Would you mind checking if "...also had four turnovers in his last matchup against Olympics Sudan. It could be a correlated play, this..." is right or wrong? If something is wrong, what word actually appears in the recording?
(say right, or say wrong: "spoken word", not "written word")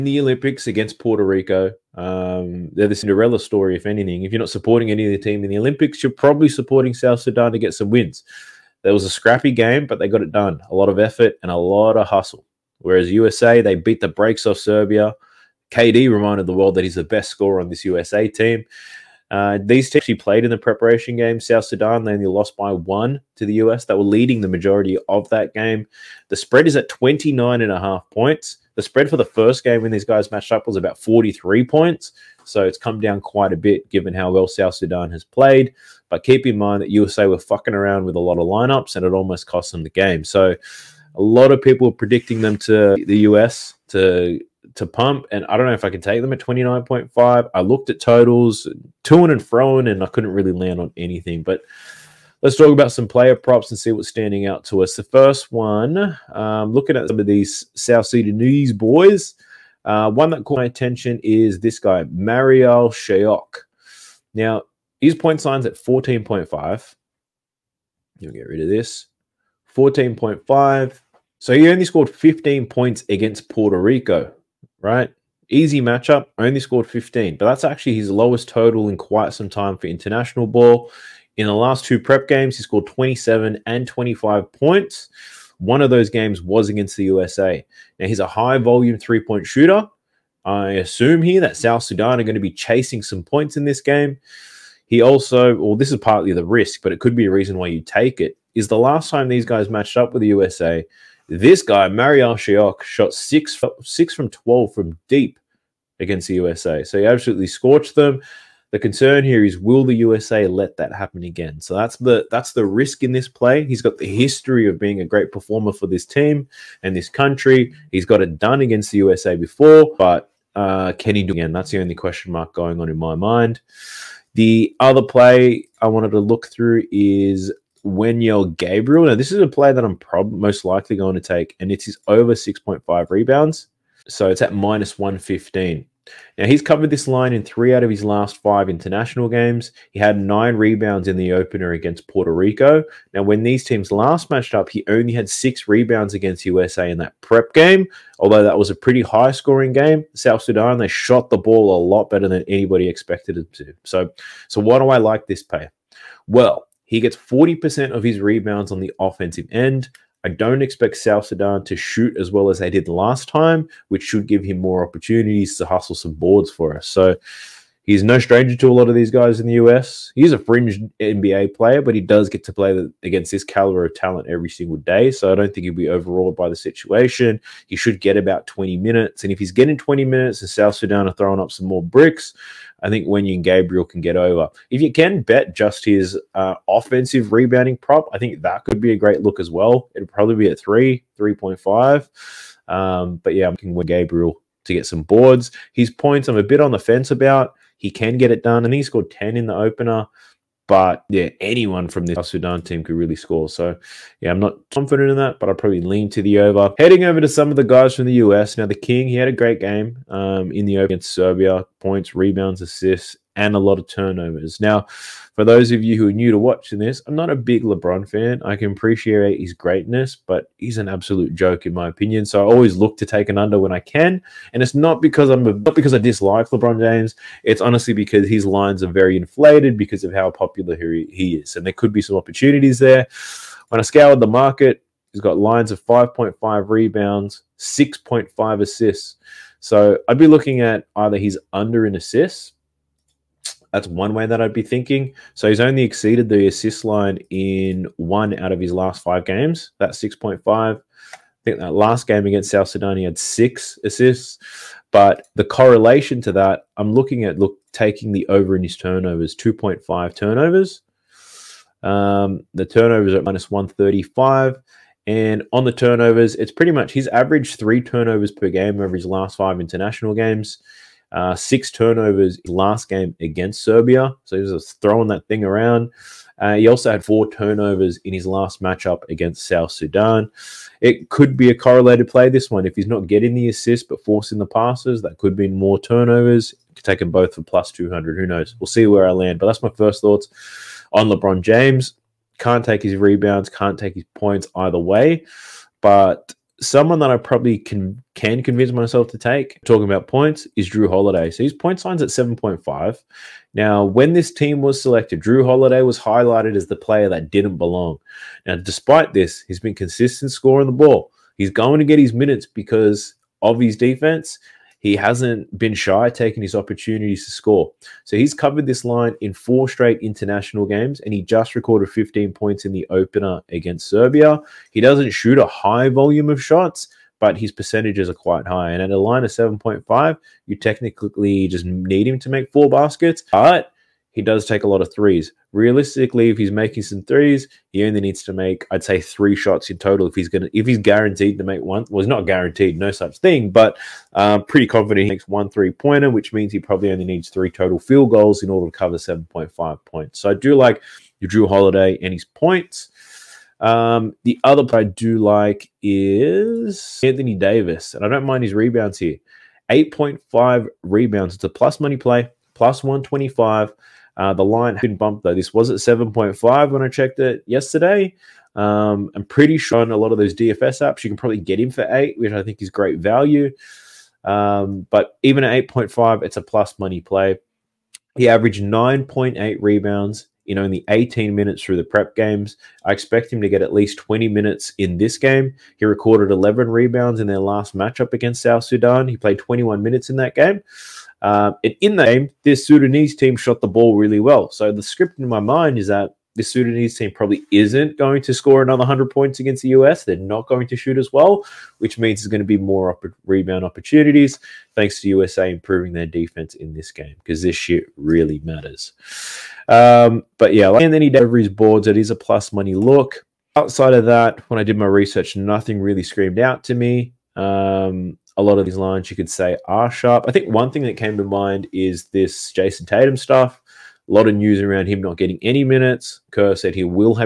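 wrong: "South", not "Olympics".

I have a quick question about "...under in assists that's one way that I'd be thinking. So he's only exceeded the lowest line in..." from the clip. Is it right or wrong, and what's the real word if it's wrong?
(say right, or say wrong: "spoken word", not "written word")
wrong: "assist", not "lowest".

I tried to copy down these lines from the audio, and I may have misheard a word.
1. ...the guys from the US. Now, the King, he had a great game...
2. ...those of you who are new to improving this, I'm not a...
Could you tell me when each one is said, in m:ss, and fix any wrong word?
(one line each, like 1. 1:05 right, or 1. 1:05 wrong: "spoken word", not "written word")
1. 3:27 right
2. 3:35 wrong: "watching", not "improving".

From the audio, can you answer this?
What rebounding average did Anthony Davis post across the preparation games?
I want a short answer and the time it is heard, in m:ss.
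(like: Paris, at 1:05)
9.8, at 6:18.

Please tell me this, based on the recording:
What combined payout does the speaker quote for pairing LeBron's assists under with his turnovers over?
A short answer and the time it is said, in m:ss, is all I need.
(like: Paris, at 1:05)
plus 200, at 4:47.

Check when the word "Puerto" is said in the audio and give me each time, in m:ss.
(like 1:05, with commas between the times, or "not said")
0:00, 1:13, 2:22.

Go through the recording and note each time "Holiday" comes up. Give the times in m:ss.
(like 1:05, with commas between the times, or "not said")
5:00, 5:05, 5:51.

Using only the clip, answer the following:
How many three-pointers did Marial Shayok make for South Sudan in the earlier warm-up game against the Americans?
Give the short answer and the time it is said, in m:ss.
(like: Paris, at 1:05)
6, at 1:43.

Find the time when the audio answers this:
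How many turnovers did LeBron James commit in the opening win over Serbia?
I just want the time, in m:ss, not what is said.
4:31.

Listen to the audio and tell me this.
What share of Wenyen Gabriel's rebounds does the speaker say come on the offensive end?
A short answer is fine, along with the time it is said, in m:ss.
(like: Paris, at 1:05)
40%, at 2:37.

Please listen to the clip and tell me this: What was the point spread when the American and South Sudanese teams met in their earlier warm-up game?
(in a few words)
43.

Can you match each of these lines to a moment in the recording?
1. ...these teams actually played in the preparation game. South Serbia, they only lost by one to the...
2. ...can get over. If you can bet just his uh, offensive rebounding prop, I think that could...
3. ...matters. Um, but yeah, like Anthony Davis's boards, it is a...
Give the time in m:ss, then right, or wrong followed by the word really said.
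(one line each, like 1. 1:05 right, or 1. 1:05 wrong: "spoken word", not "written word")
1. 0:19 wrong: "Sudan", not "Serbia"
2. 3:03 right
3. 6:48 right.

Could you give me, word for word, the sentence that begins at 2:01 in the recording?
That's the only question mark going on in my mind.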